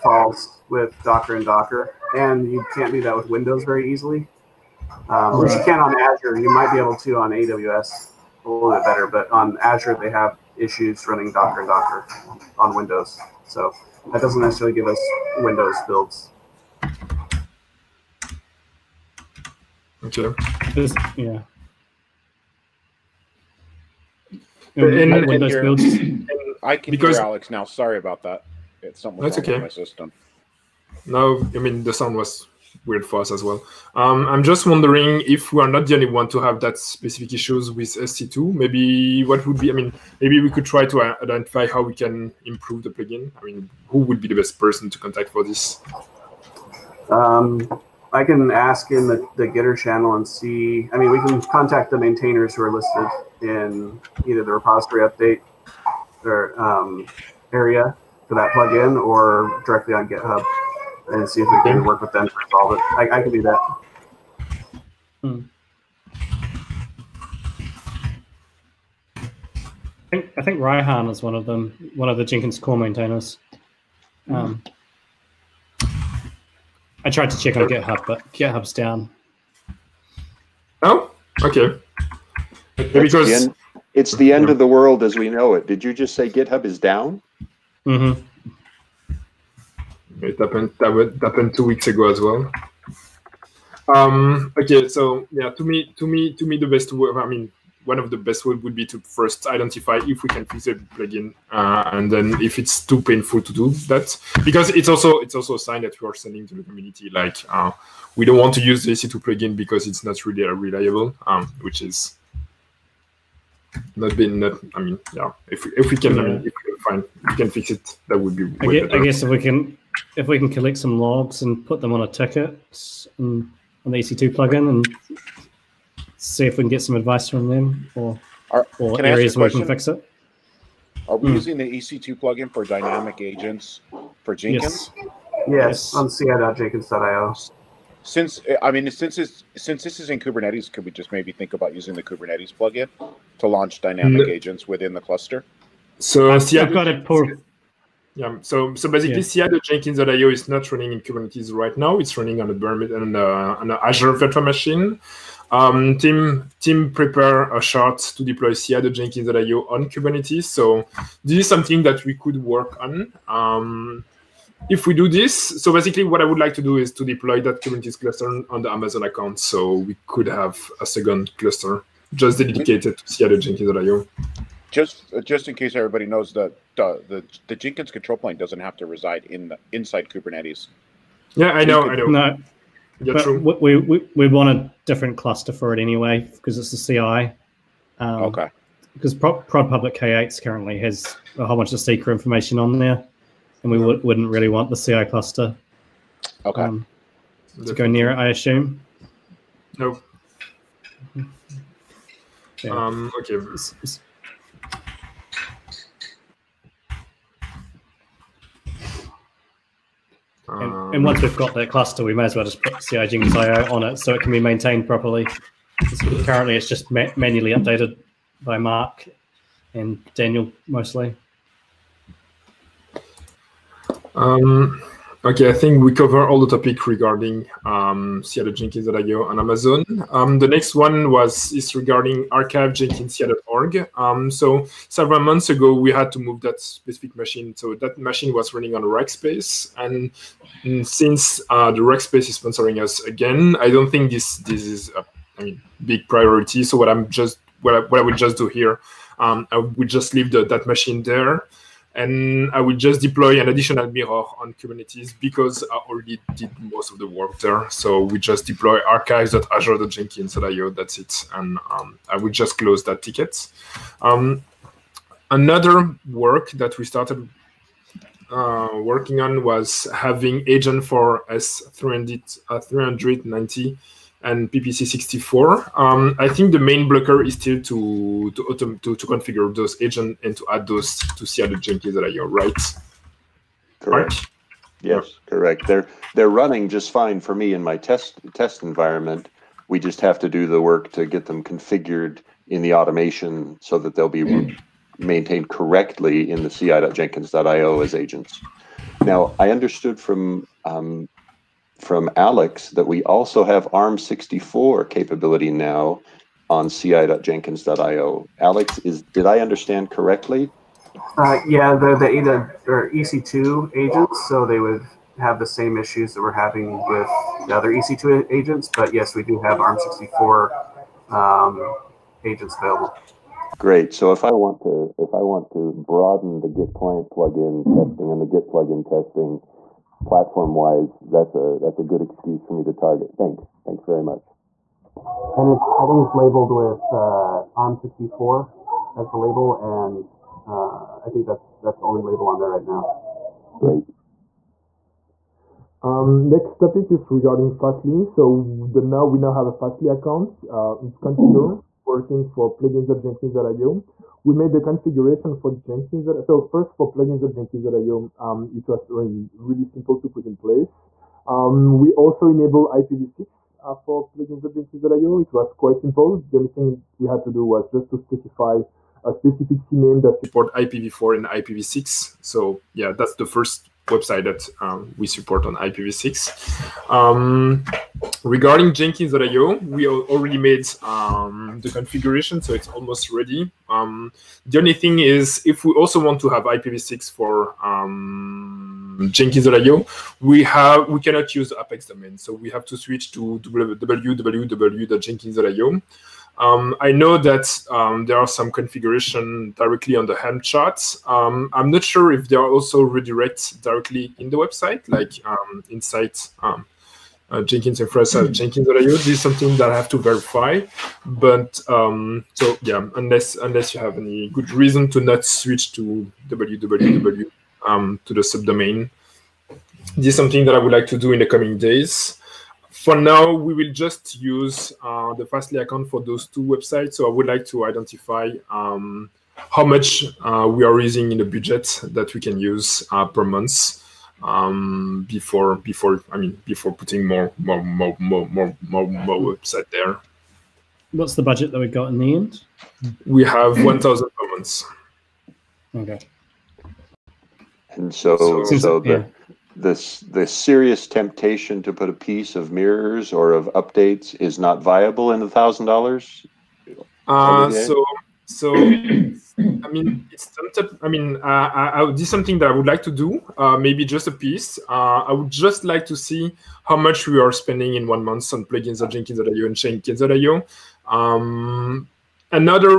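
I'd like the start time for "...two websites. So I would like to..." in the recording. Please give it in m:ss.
7:06.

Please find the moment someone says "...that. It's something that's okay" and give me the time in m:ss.
0:28.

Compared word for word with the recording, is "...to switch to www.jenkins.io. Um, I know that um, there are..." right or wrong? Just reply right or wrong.
right.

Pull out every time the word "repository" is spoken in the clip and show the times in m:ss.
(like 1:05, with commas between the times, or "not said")
0:54.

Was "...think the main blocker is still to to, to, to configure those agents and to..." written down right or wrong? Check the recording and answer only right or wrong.
right.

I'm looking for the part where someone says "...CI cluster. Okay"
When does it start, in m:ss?
3:14.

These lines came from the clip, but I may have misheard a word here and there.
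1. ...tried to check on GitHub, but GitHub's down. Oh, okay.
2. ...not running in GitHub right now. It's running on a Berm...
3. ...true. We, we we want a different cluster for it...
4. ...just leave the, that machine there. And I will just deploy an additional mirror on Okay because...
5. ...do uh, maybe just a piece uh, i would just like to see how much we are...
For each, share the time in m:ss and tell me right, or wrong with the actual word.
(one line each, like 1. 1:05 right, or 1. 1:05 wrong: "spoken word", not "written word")
1. 1:17 right
2. 2:30 wrong: "Kubernetes", not "GitHub"
3. 3:03 right
4. 4:09 wrong: "Kubernetes", not "Okay"
5. 7:42 right.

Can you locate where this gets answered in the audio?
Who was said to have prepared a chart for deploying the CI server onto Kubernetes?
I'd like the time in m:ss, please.
2:35.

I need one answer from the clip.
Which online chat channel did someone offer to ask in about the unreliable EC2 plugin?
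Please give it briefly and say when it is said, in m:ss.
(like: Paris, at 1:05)
Gitter, at 0:49.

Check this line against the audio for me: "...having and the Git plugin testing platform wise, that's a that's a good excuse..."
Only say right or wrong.
wrong.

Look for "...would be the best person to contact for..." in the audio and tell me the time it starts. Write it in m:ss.
0:43.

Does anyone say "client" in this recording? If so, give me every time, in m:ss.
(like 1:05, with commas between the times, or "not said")
5:26.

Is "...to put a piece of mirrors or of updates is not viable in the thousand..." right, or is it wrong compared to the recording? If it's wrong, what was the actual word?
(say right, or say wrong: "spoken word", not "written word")
right.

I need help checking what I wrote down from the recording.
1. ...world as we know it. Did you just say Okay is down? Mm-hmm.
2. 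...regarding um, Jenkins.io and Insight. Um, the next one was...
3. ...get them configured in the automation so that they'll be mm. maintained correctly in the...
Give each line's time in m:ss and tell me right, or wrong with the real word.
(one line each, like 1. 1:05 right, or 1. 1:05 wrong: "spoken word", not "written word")
1. 1:24 wrong: "GitHub", not "Okay"
2. 3:46 wrong: "Amazon", not "Insight"
3. 4:51 right.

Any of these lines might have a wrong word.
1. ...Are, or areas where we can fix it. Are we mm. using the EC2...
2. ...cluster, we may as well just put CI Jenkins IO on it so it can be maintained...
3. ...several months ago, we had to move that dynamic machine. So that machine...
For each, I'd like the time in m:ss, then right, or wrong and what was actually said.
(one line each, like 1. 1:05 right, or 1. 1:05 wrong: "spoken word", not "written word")
1. 2:08 right
2. 3:31 right
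3. 3:54 wrong: "specific", not "dynamic".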